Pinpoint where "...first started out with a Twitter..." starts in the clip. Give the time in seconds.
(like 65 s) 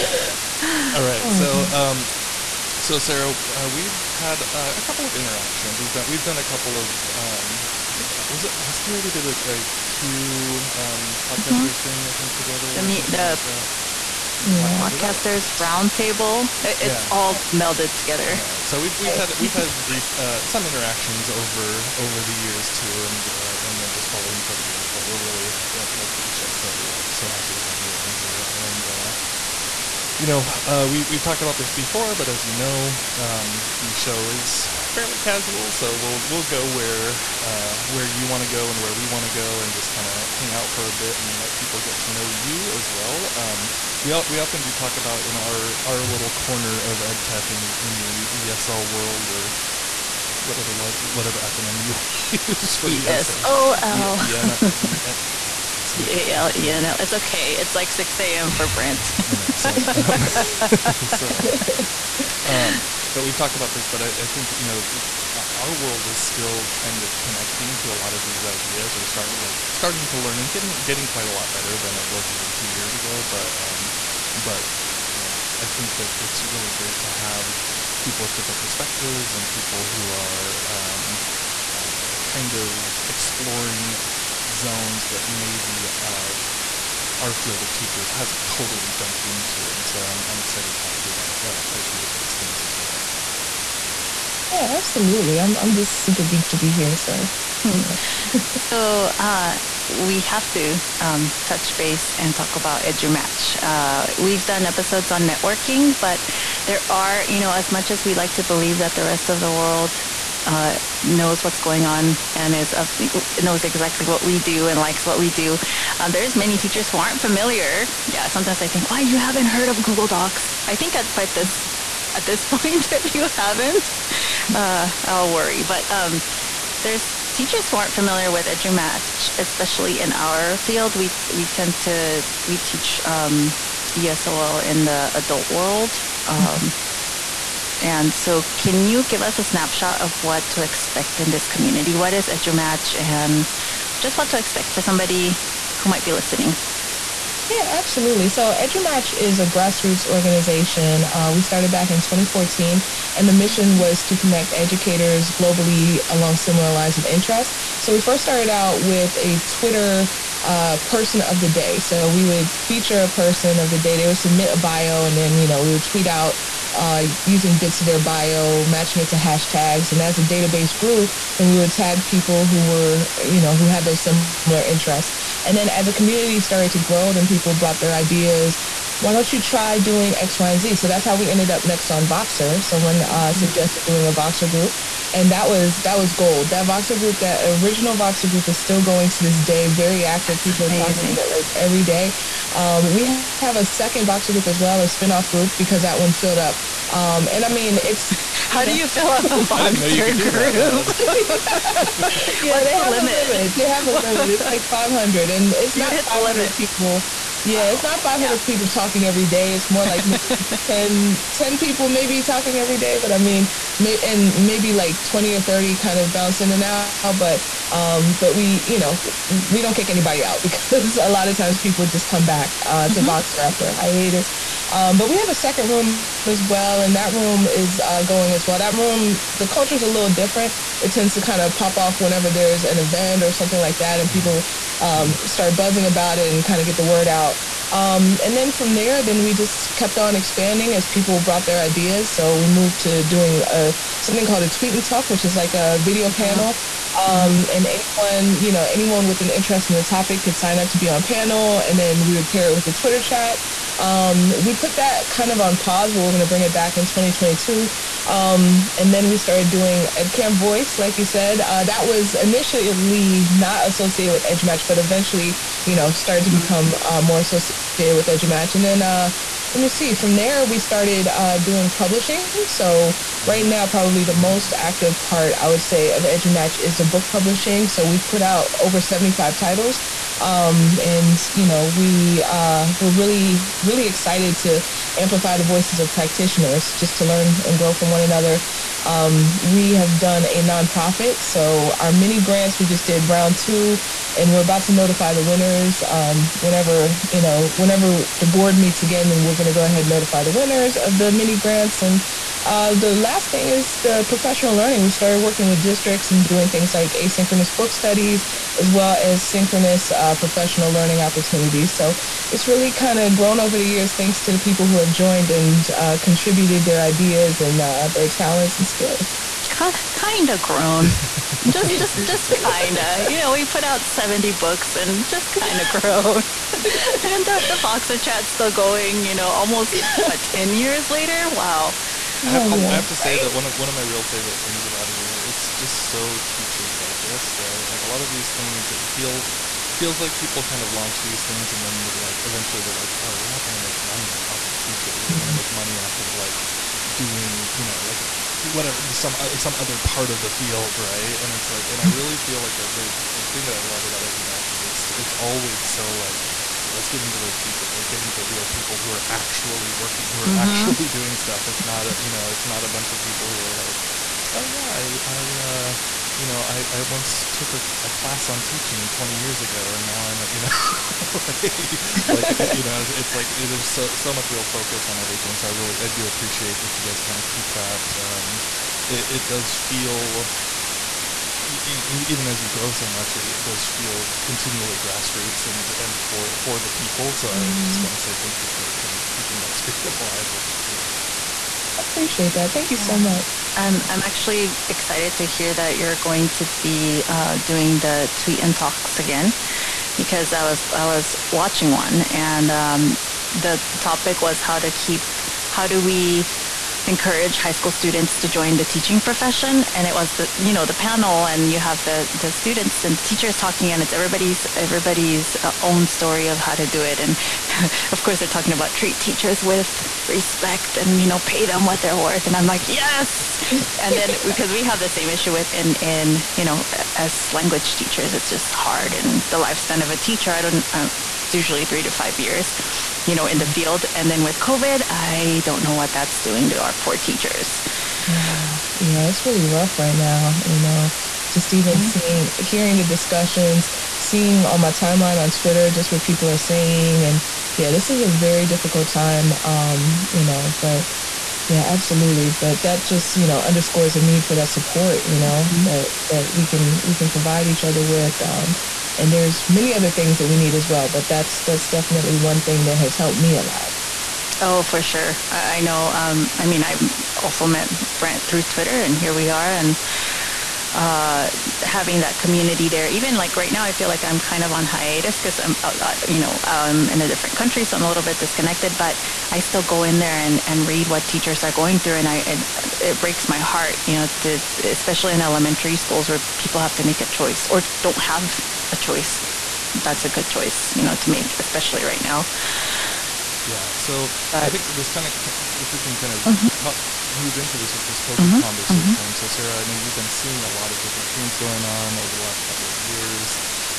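158 s.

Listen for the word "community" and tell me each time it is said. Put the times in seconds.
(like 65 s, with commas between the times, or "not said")
141 s, 175 s, 472 s.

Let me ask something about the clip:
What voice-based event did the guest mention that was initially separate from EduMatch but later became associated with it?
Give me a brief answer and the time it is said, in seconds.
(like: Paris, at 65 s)
EdCamp Voice, at 259 s.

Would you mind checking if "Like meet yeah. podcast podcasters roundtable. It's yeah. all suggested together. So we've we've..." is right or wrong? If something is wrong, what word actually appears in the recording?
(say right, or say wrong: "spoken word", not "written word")
wrong: "melded", not "suggested".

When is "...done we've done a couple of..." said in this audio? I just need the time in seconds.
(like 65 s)
5 s.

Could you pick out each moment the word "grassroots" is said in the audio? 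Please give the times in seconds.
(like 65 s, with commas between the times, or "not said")
149 s, 384 s.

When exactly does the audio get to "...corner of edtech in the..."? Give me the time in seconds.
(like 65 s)
46 s.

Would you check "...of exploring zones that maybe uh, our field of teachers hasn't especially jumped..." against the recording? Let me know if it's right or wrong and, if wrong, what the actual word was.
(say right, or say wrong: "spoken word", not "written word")
wrong: "totally", not "especially".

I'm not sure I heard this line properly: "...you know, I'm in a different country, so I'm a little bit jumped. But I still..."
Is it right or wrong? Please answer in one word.
wrong.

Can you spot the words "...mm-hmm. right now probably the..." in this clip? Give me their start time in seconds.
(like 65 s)
273 s.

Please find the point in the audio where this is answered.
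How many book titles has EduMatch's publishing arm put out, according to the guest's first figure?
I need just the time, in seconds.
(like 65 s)
278 s.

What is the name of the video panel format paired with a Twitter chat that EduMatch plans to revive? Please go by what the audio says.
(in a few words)
tweet and talk.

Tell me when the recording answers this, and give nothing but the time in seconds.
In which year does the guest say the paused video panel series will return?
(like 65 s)
256 s.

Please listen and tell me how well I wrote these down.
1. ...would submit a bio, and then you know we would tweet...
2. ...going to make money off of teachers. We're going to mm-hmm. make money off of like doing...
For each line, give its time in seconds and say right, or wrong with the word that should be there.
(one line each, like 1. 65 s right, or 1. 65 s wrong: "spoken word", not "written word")
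1. 164 s right
2. 343 s right.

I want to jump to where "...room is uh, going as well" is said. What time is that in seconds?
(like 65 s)
227 s.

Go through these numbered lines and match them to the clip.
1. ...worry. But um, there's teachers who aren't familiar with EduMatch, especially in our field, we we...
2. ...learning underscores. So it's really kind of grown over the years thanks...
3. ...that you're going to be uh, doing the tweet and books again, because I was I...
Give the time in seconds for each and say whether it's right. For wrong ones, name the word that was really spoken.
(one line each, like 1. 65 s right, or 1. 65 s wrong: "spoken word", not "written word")
1. 125 s right
2. 310 s wrong: "opportunities", not "underscores"
3. 395 s wrong: "talks", not "books".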